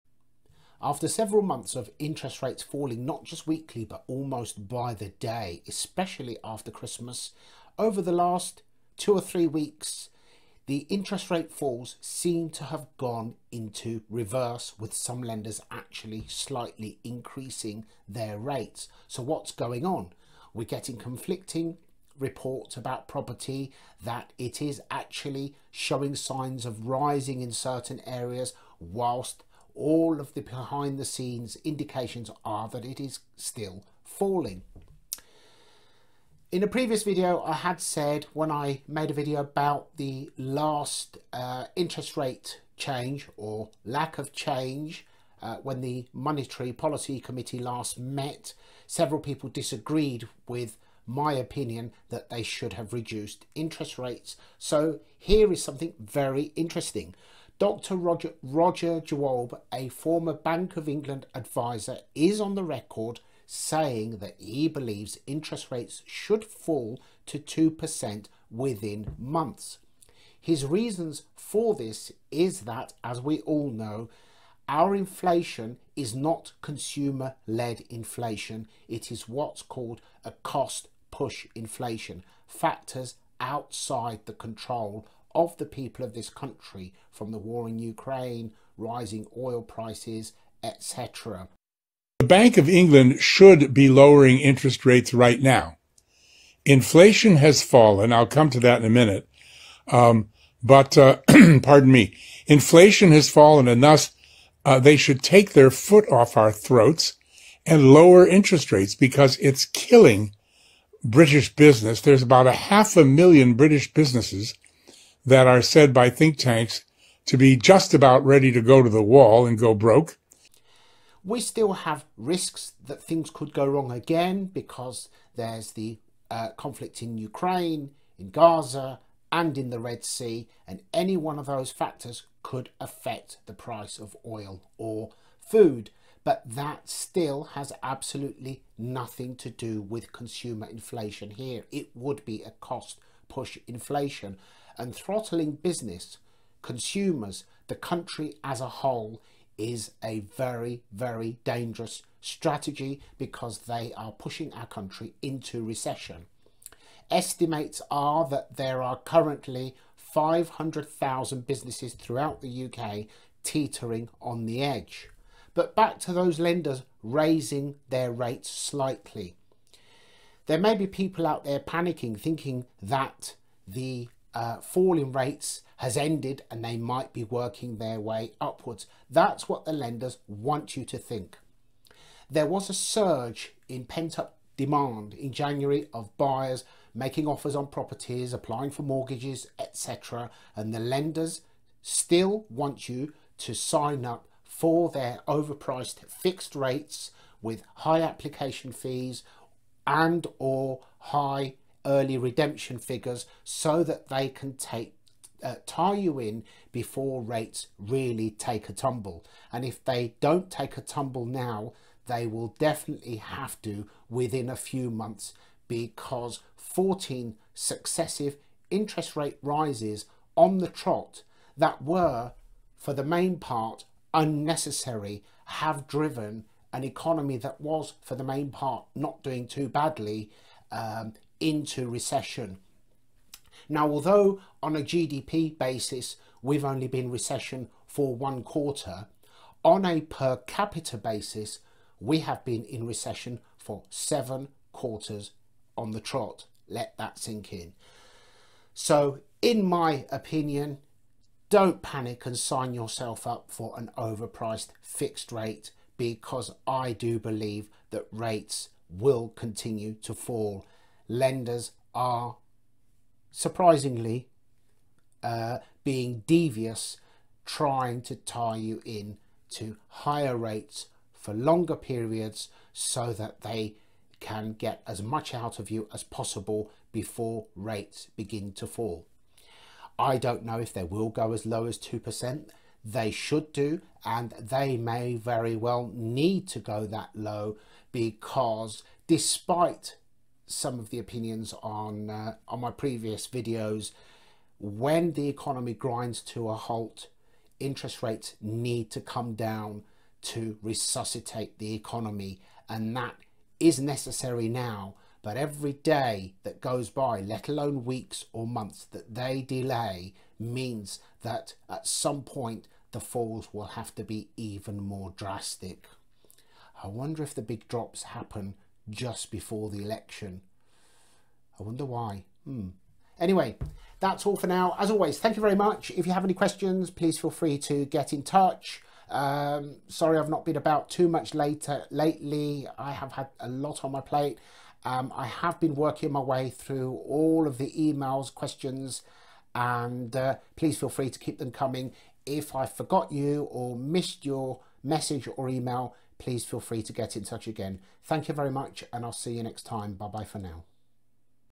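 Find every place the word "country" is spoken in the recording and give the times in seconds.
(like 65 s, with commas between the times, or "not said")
86 s, 147 s, 154 s.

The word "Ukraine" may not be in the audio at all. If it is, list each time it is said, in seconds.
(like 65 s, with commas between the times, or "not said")
87 s, 127 s.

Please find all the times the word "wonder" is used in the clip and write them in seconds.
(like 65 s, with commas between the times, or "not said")
316 s, 321 s.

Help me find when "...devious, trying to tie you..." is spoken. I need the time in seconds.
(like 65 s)
266 s.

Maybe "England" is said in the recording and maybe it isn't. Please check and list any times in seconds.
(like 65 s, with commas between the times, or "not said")
60 s, 92 s.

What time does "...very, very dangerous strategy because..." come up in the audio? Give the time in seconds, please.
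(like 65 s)
150 s.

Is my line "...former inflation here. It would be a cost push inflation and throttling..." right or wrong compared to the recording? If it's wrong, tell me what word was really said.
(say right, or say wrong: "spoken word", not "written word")
wrong: "consumer", not "former".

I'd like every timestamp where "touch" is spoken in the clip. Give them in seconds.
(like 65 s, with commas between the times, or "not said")
328 s, 347 s.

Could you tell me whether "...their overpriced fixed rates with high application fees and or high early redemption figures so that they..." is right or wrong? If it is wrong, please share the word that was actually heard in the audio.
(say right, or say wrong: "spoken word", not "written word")
right.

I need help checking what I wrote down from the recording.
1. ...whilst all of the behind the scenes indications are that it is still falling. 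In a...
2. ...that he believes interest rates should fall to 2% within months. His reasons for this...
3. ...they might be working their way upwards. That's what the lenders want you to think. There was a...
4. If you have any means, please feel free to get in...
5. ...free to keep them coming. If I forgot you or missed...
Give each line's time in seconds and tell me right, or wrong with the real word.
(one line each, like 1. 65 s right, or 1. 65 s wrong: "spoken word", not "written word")
1. 28 s right
2. 64 s right
3. 176 s right
4. 325 s wrong: "questions", not "means"
5. 340 s right.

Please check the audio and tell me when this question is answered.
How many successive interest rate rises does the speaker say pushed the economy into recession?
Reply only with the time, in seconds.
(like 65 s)
216 s.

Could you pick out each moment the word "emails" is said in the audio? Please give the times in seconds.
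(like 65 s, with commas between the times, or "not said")
337 s, 345 s.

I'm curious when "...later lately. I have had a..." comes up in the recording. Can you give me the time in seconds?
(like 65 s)
331 s.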